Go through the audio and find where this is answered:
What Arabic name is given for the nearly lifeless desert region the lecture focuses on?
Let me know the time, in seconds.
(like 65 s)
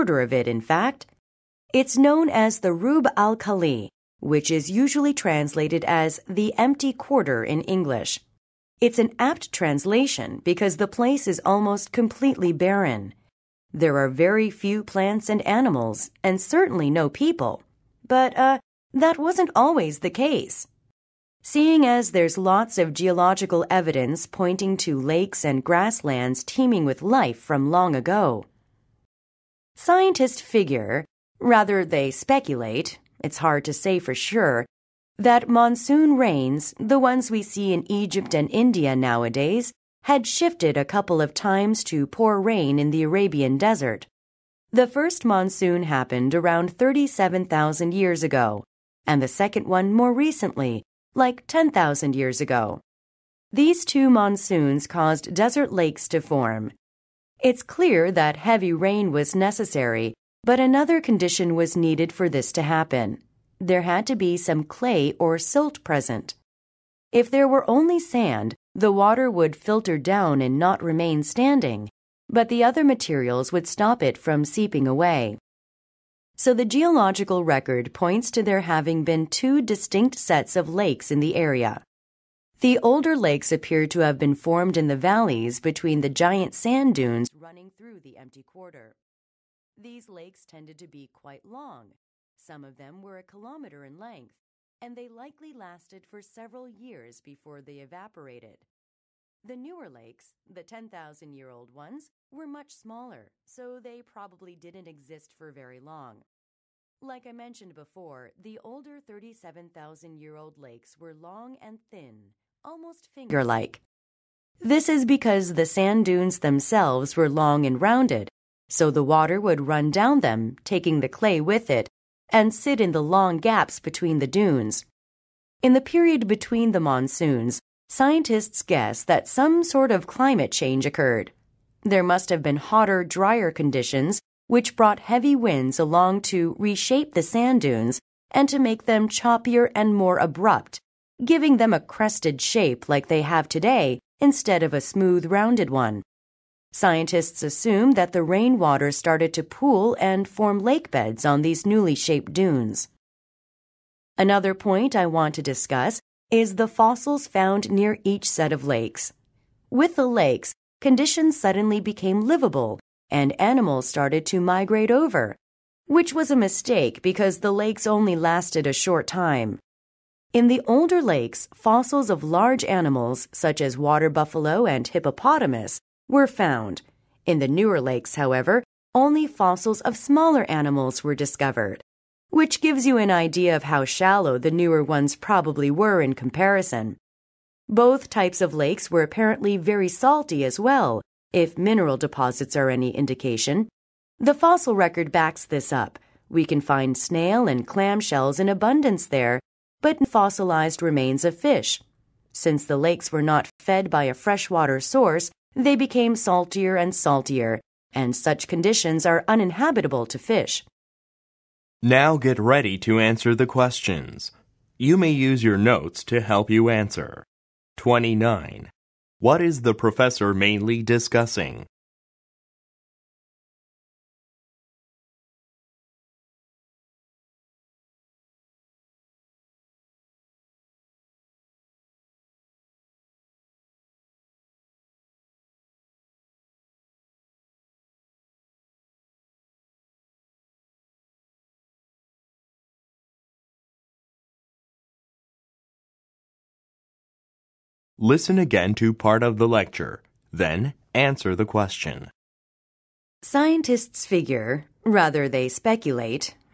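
2 s.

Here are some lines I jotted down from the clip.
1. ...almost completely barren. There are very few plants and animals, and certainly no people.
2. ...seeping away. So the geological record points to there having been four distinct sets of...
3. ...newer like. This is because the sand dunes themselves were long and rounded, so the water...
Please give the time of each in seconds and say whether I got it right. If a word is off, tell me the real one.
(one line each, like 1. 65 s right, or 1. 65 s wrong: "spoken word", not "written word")
1. 11 s right
2. 74 s wrong: "two", not "four"
3. 113 s wrong: "finger", not "newer".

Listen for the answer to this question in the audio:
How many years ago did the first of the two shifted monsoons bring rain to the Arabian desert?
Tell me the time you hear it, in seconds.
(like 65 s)
46 s.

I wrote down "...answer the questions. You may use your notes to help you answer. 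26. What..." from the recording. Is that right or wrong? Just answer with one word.
wrong.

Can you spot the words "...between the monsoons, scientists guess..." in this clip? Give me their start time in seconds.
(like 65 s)
126 s.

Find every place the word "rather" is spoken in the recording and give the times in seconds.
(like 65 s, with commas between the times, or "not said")
31 s, 254 s.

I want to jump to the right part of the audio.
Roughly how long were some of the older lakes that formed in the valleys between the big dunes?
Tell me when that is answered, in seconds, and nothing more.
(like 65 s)
93 s.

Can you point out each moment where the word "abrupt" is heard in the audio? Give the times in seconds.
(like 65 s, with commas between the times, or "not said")
140 s.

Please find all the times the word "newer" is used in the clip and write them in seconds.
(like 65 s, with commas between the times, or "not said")
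99 s, 177 s, 184 s.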